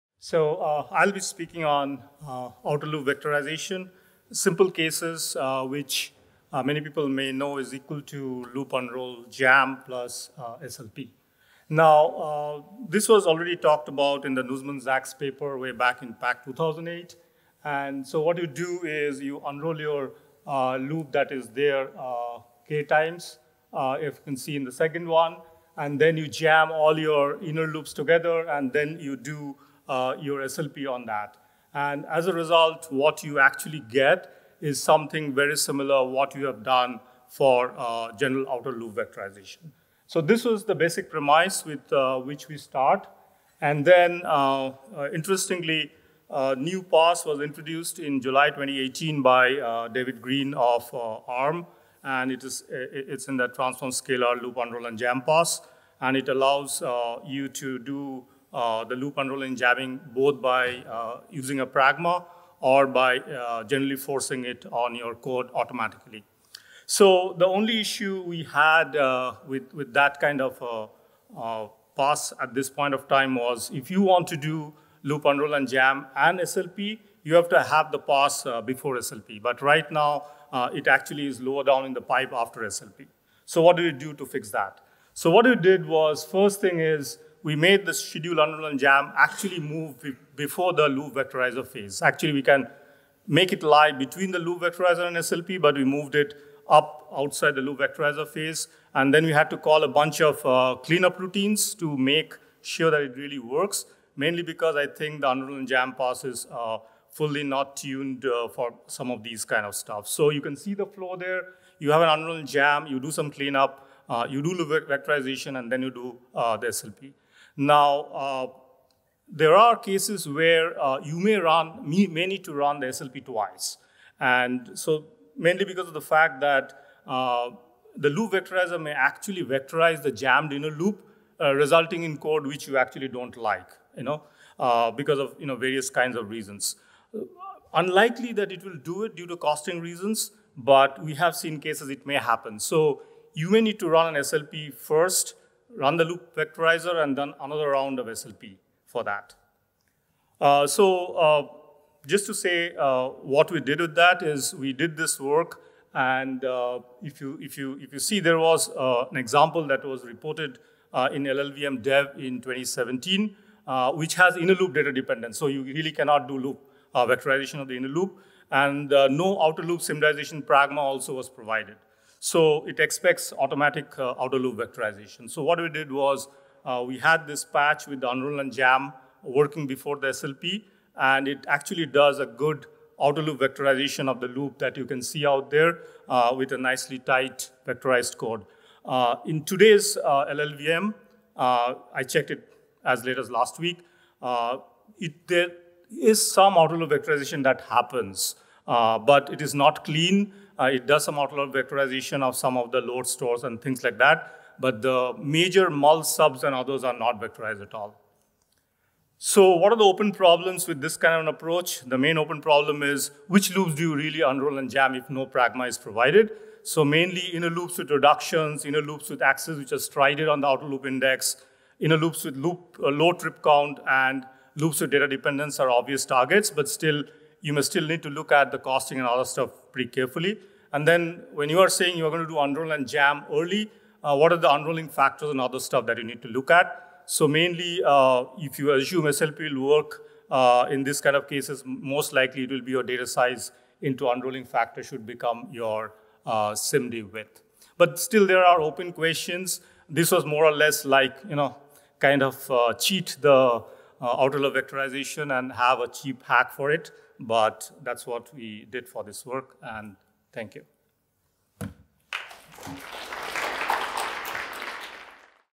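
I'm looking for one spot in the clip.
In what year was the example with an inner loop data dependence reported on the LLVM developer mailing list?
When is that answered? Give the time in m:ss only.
2:42.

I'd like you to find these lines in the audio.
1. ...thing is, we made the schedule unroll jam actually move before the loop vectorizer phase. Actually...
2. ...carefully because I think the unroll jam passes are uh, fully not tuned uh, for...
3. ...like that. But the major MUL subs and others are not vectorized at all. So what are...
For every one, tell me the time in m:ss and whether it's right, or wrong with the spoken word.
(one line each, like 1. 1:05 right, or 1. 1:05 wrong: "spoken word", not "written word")
1. 1:26 right
2. 1:44 wrong: "mainly", not "carefully"
3. 3:23 right.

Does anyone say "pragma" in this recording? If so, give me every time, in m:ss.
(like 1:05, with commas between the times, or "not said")
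1:01, 2:50, 3:35.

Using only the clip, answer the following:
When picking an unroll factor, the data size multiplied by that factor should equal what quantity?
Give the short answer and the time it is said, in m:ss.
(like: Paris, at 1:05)
SIMD width, at 4:06.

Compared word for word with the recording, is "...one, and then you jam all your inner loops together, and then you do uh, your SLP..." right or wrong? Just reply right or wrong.
right.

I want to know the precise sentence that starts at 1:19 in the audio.
But right now, uh, it actually is lower down in the pipe after SLP.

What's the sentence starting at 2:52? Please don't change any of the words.
So it expects automatic uh, outer loop vectorization.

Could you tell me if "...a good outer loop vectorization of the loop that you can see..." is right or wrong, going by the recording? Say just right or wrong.
right.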